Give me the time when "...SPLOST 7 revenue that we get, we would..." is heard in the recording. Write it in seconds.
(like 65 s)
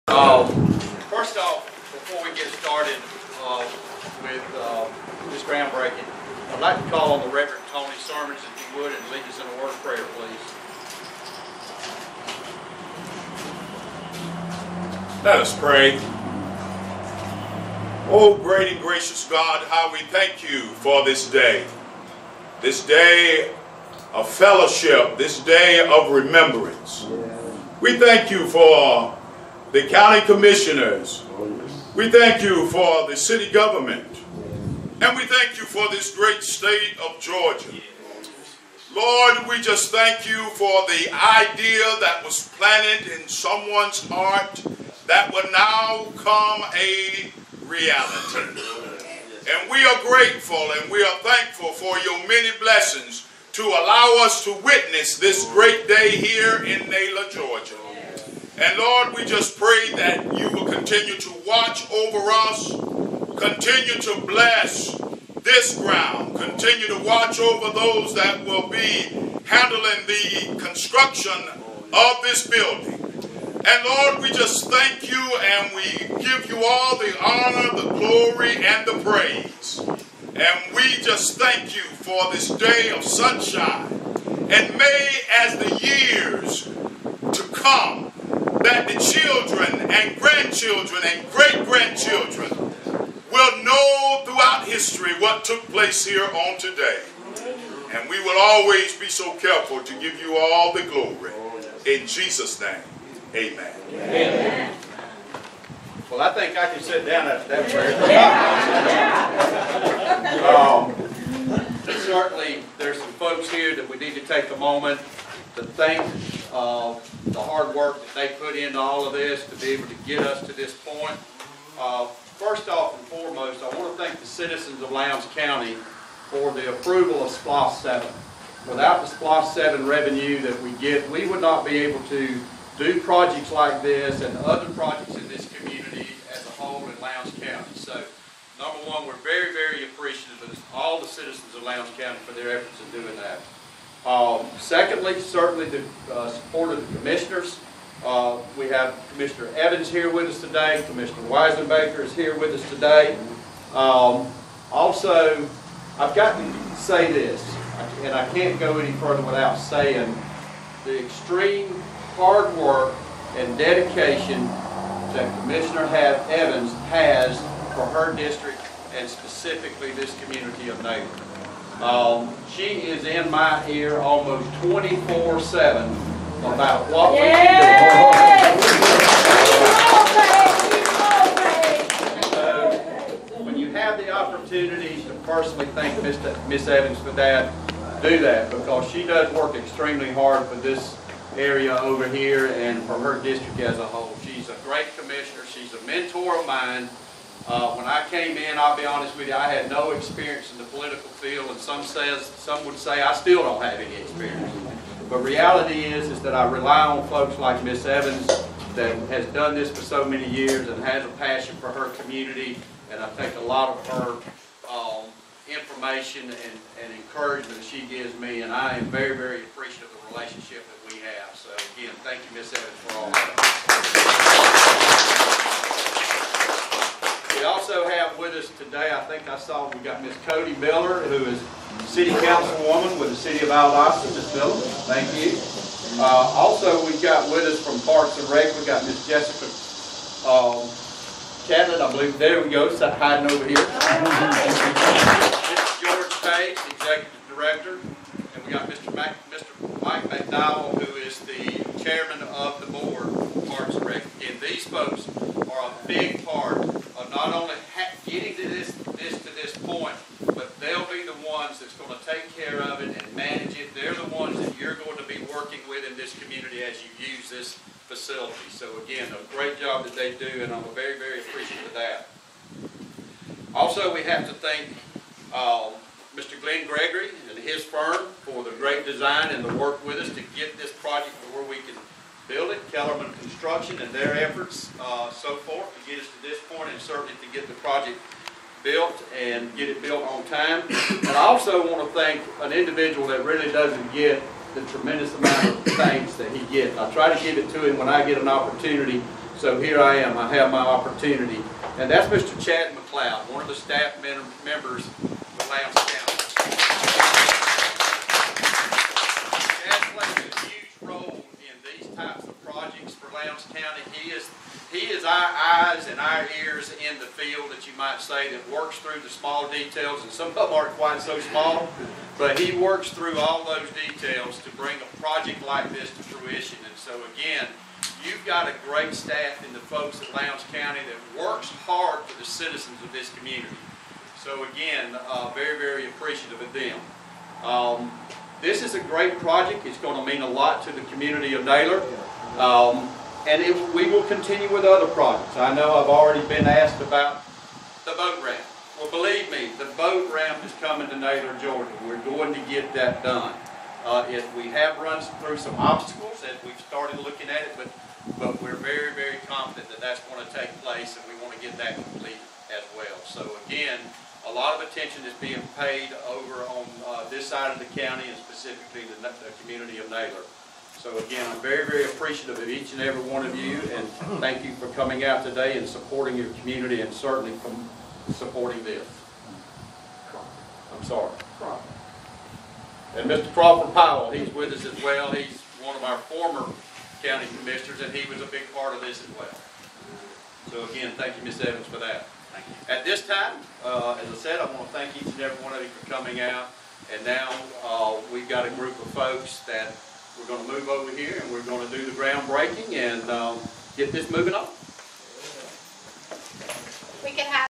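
129 s.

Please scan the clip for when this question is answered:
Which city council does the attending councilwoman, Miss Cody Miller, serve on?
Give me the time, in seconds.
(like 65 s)
233 s.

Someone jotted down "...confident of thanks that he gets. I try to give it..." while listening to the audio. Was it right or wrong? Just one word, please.
wrong.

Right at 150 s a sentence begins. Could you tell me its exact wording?
Commissioner Wisenbaker is here with us today.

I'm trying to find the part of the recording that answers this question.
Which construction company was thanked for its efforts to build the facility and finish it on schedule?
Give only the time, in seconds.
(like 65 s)
282 s.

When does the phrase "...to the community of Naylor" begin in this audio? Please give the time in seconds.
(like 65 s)
340 s.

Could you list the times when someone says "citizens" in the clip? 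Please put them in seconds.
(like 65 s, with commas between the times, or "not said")
124 s, 141 s, 332 s.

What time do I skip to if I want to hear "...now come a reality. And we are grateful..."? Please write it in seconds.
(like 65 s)
45 s.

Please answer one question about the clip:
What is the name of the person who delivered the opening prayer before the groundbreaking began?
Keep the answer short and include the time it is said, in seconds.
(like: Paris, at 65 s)
Tony Sermons, at 7 s.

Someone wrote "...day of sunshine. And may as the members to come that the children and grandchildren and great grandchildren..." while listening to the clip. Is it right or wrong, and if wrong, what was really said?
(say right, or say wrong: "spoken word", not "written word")
wrong: "years", not "members".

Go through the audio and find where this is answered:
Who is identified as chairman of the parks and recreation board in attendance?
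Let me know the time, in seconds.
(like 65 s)
249 s.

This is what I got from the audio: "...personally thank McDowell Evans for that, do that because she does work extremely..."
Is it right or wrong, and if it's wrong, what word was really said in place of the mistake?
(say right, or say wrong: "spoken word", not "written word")
wrong: "Miss", not "McDowell".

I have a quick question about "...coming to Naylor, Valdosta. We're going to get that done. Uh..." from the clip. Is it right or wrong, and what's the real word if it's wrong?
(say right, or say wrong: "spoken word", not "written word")
wrong: "Georgia", not "Valdosta".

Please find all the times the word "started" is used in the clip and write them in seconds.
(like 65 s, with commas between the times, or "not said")
2 s, 356 s.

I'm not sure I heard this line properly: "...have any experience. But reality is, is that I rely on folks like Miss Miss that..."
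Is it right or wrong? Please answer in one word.
wrong.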